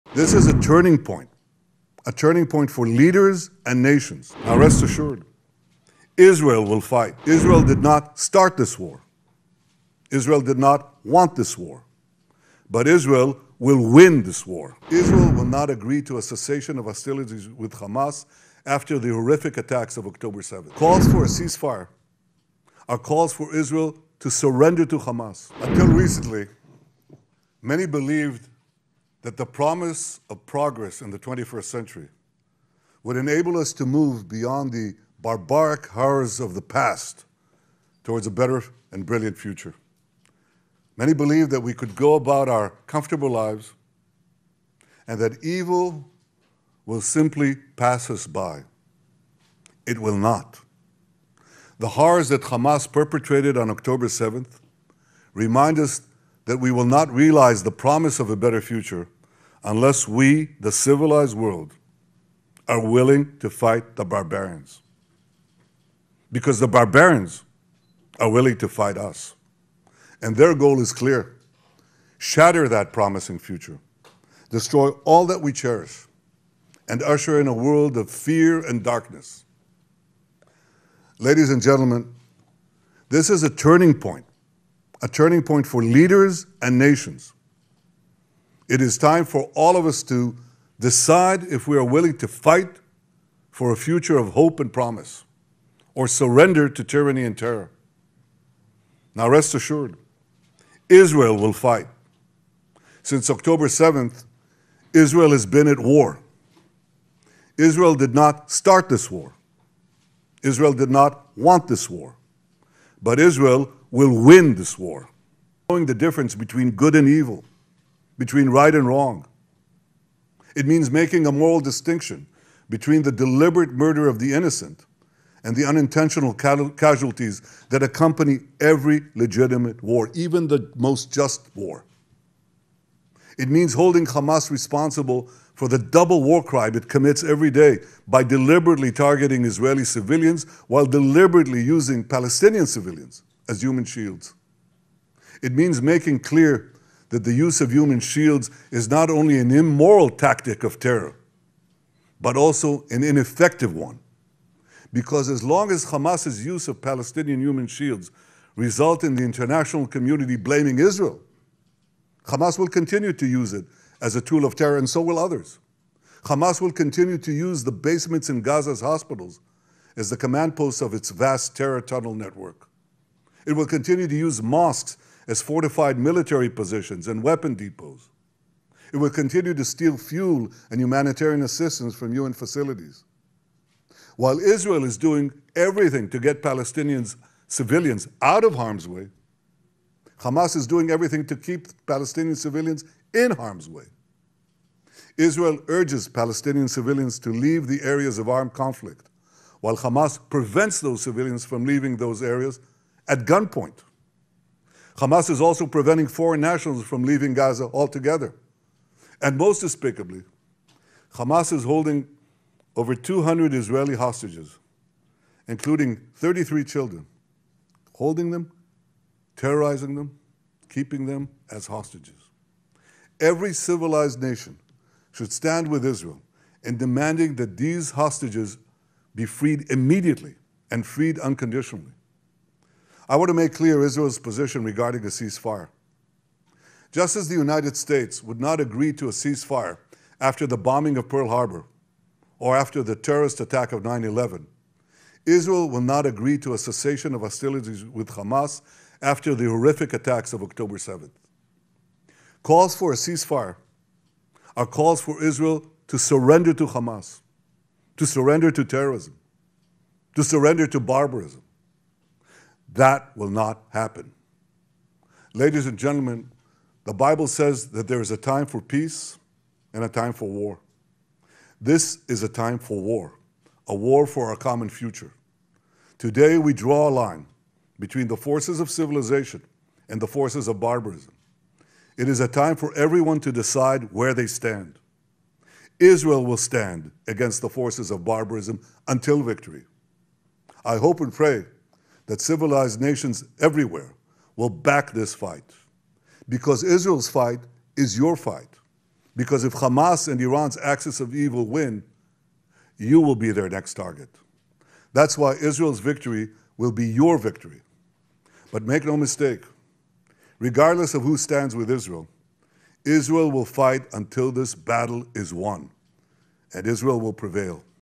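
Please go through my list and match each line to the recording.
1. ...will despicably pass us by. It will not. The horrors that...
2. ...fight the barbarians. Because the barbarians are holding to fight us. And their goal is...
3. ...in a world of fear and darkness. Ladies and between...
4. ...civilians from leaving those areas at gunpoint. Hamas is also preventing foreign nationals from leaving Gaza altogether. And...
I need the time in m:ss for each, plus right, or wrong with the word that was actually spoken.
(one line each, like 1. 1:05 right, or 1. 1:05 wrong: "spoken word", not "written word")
1. 0:46 wrong: "simply", not "despicably"
2. 1:03 wrong: "willing", not "holding"
3. 1:17 wrong: "gentlemen", not "between"
4. 3:21 right.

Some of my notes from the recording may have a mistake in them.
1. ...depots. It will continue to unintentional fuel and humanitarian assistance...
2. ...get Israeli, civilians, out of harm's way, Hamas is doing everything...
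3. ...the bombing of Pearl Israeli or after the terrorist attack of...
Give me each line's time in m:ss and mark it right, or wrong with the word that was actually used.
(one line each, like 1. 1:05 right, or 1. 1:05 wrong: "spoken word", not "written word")
1. 2:57 wrong: "steal", not "unintentional"
2. 3:06 wrong: "Palestinians", not "Israeli"
3. 4:00 wrong: "Harbor", not "Israeli".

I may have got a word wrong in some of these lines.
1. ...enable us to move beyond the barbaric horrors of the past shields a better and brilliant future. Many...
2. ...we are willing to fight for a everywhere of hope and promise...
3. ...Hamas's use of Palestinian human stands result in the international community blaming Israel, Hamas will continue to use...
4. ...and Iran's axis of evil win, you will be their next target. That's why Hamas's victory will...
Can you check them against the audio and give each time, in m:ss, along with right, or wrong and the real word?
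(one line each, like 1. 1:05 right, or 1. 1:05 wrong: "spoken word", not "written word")
1. 0:33 wrong: "towards", not "shields"
2. 1:31 wrong: "future", not "everywhere"
3. 2:35 wrong: "shields", not "stands"
4. 5:00 wrong: "Israel", not "Hamas".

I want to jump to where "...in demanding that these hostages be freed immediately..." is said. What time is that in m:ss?
3:46.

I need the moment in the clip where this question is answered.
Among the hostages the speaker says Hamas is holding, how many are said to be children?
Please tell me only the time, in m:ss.
3:36.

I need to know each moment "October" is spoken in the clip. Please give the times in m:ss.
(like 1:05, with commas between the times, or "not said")
0:20, 0:53, 1:43, 4:10.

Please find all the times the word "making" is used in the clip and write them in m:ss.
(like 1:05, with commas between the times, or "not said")
2:00, 2:25.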